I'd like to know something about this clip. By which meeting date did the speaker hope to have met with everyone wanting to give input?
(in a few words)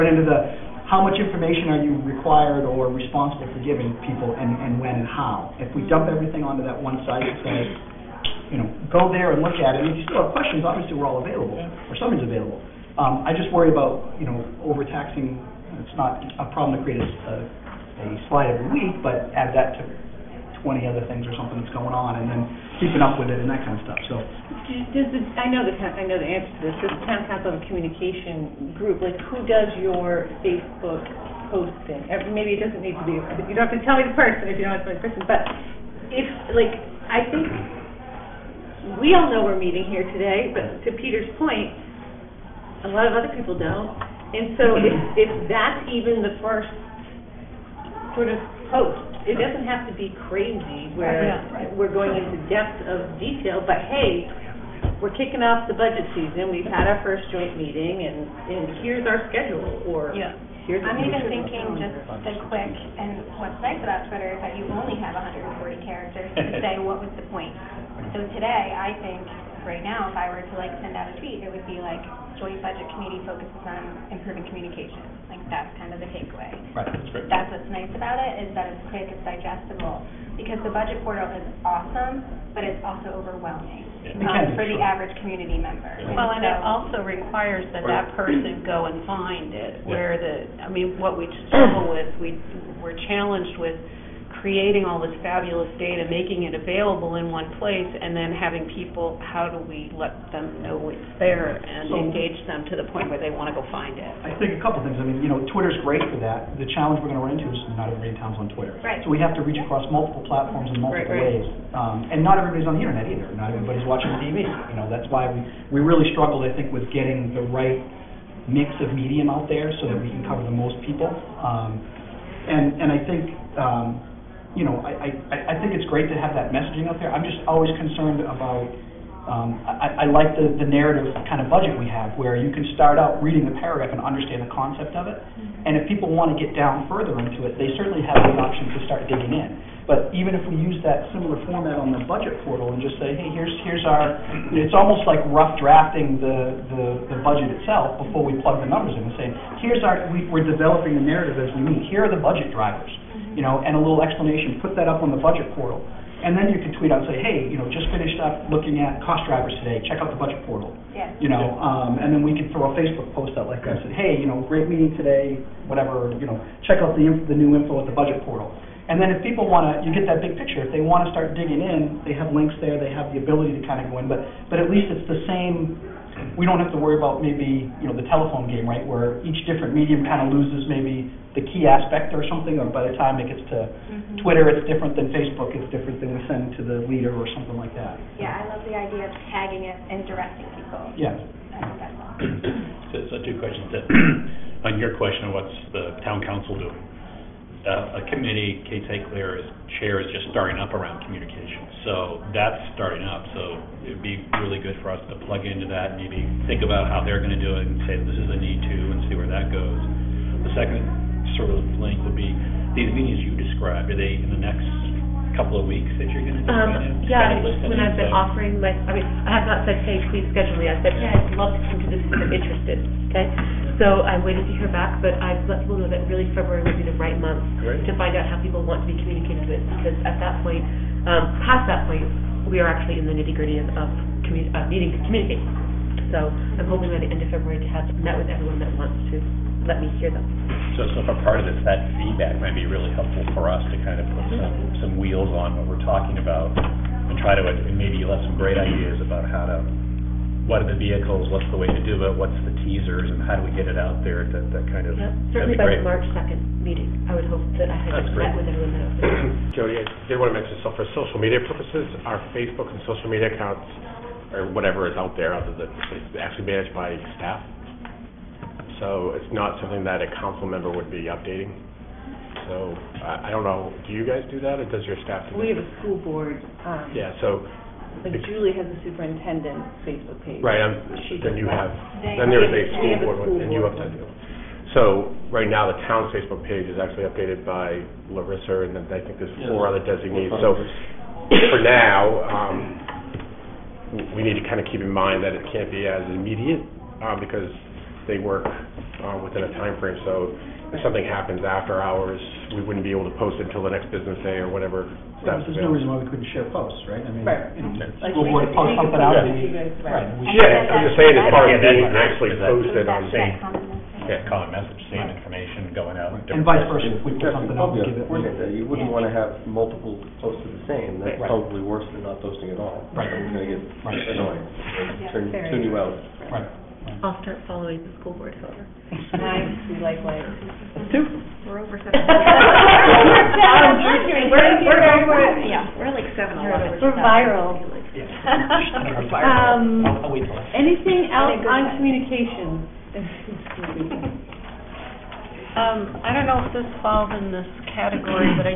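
March 2.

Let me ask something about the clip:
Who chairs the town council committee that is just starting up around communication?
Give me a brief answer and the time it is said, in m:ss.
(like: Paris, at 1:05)
Kate St. Clair, at 3:18.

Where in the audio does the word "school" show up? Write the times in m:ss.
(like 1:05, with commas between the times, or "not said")
4:35, 4:42, 5:08, 5:28.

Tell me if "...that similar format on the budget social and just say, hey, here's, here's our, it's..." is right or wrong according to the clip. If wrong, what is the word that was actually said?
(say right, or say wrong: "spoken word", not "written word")
wrong: "portal", not "social".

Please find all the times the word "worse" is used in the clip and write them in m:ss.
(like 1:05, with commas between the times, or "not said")
5:21.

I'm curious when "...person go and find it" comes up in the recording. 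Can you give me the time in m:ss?
1:28.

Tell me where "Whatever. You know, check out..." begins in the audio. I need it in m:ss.
2:45.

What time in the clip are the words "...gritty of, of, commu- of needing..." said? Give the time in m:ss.
3:53.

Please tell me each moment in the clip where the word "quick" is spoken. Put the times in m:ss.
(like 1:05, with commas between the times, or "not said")
1:02, 1:18.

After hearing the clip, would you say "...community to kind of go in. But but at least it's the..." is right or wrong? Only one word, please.
wrong.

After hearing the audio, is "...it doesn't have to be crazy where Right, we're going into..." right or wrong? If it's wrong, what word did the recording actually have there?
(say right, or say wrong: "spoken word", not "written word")
right.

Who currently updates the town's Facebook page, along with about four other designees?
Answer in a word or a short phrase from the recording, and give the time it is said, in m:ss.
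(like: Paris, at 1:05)
Larissa, at 4:48.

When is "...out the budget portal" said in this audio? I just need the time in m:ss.
2:40.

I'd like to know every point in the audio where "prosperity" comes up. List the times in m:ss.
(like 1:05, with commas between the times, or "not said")
not said.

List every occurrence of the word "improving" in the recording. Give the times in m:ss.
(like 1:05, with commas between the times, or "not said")
1:14.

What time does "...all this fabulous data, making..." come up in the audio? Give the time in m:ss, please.
1:34.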